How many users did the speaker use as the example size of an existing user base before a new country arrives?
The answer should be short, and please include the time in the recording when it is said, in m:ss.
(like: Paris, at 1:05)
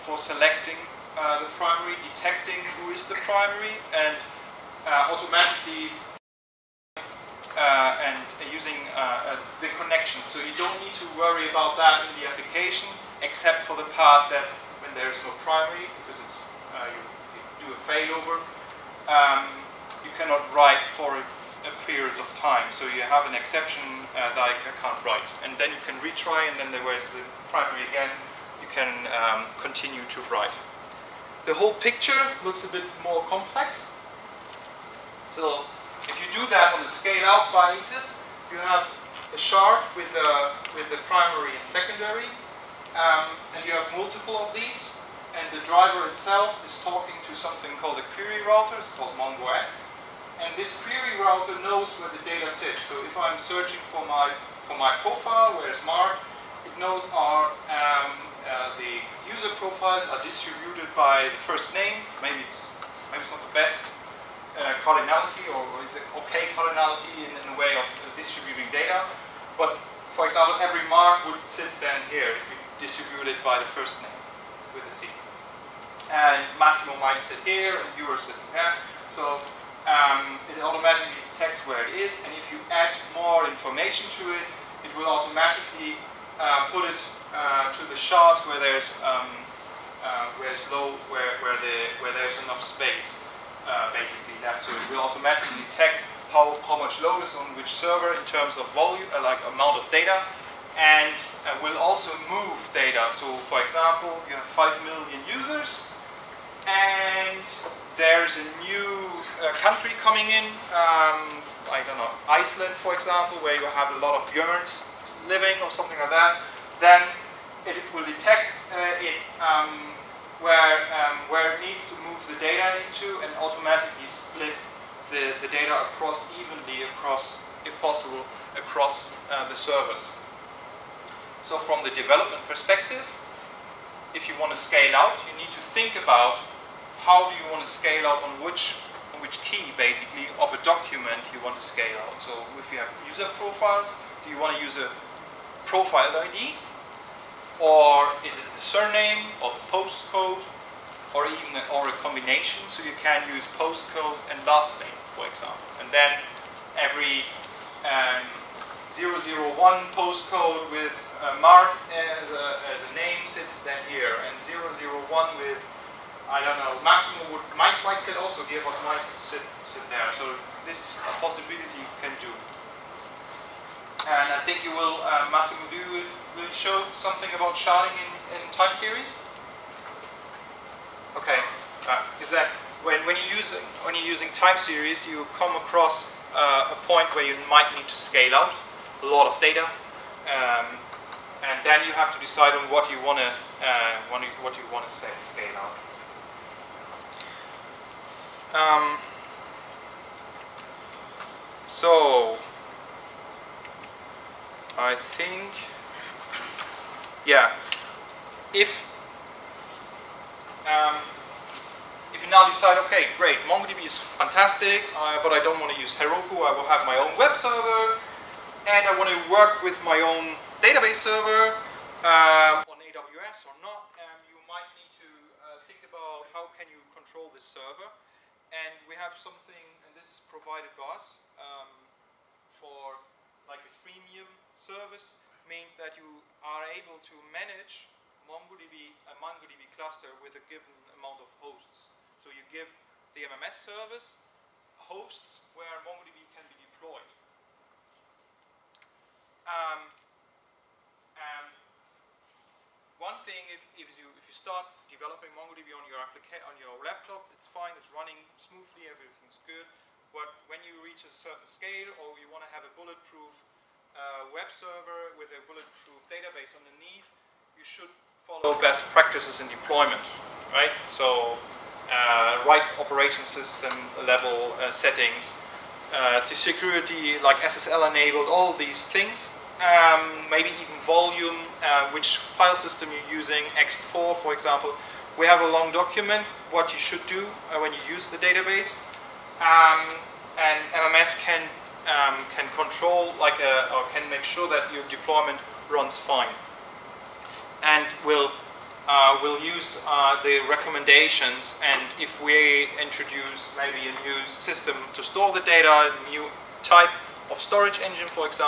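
5 million, at 1:44.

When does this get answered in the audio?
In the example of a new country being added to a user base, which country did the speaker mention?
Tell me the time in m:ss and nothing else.
1:52.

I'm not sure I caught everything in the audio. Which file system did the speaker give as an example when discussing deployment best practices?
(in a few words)
ext4.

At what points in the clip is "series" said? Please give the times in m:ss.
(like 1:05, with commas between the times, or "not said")
2:58, 3:04.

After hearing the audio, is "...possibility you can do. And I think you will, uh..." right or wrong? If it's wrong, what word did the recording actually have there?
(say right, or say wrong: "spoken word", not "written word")
right.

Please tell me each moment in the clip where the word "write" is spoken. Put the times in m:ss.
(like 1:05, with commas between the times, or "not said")
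0:20, 0:25, 0:30.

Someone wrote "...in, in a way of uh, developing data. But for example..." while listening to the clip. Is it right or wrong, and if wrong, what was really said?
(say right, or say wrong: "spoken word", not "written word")
wrong: "distributing", not "developing".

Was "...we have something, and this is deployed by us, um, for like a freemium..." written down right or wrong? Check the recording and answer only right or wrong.
wrong.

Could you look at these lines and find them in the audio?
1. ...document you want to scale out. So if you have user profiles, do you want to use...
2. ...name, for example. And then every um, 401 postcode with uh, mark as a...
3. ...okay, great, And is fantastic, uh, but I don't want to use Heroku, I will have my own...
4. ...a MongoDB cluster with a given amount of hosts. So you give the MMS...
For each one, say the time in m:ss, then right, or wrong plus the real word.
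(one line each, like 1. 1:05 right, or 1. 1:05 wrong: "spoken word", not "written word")
1. 2:20 right
2. 2:34 wrong: "001", not "401"
3. 3:32 wrong: "MongoDB", not "And"
4. 3:59 right.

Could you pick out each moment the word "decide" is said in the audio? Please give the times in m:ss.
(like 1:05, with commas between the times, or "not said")
3:12, 3:32.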